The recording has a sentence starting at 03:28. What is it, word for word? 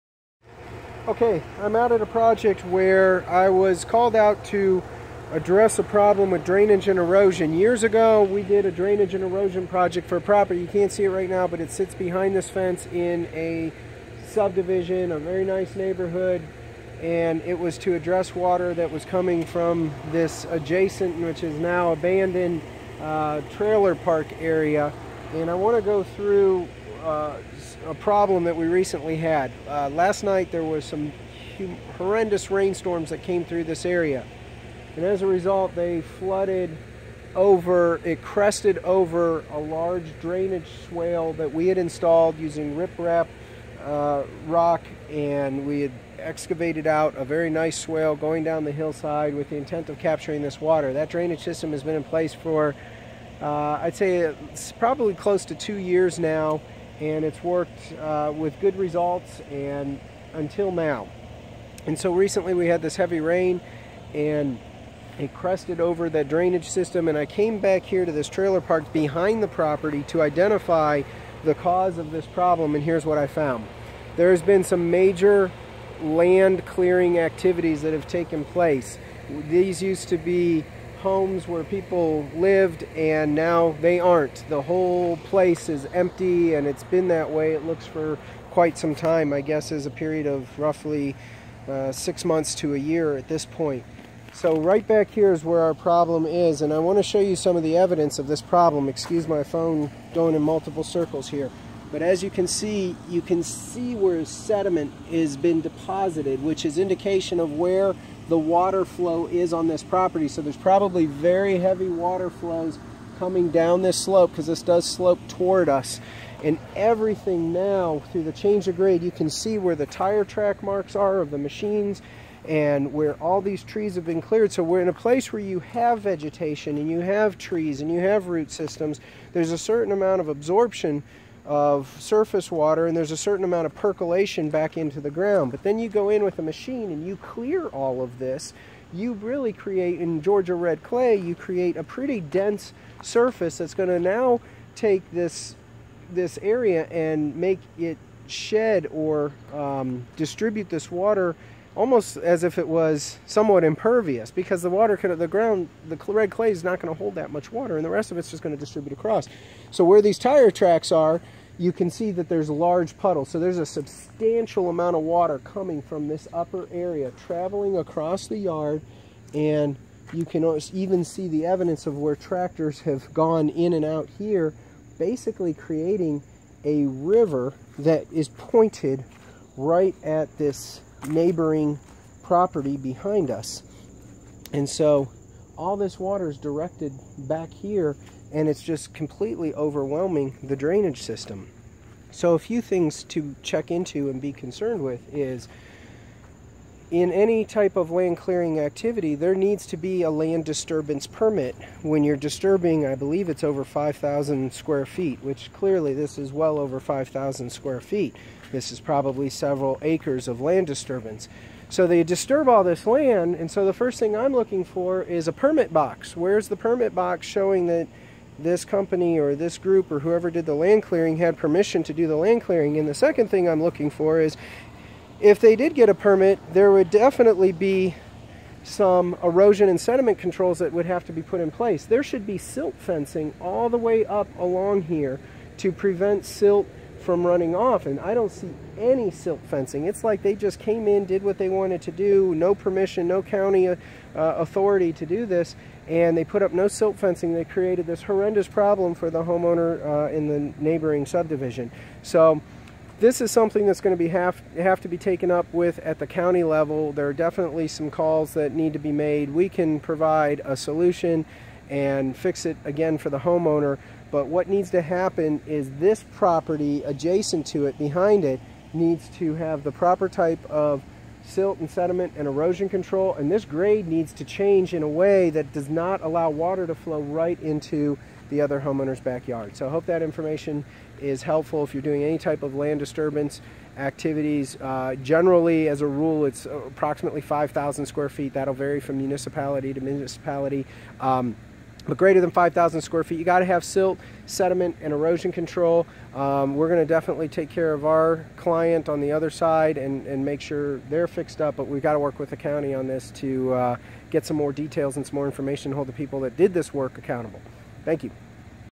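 This is probably several acres of land disturbance.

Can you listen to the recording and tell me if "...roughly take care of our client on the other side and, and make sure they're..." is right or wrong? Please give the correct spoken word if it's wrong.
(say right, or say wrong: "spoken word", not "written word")
wrong: "definitely", not "roughly".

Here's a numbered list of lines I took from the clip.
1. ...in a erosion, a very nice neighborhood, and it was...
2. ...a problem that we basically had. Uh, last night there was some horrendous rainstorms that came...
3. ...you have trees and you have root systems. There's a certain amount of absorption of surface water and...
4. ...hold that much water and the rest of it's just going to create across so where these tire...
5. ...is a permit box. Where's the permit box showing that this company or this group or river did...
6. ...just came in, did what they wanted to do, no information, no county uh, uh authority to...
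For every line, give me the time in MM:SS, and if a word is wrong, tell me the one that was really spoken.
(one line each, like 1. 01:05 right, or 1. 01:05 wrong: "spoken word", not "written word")
1. 00:12 wrong: "subdivision", not "erosion"
2. 00:27 wrong: "recently", not "basically"
3. 02:06 right
4. 02:36 wrong: "distribute", not "create"
5. 03:35 wrong: "whoever", not "river"
6. 04:00 wrong: "permission", not "information".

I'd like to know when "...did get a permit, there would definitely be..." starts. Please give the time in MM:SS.
03:45.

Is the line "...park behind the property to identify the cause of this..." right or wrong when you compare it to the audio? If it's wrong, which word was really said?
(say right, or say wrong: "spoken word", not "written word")
right.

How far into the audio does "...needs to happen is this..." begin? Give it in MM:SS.
04:24.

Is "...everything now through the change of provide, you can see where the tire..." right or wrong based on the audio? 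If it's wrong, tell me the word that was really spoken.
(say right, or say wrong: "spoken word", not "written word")
wrong: "grade", not "provide".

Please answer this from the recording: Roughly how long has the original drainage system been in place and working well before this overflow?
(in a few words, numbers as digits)
Close to 2 years.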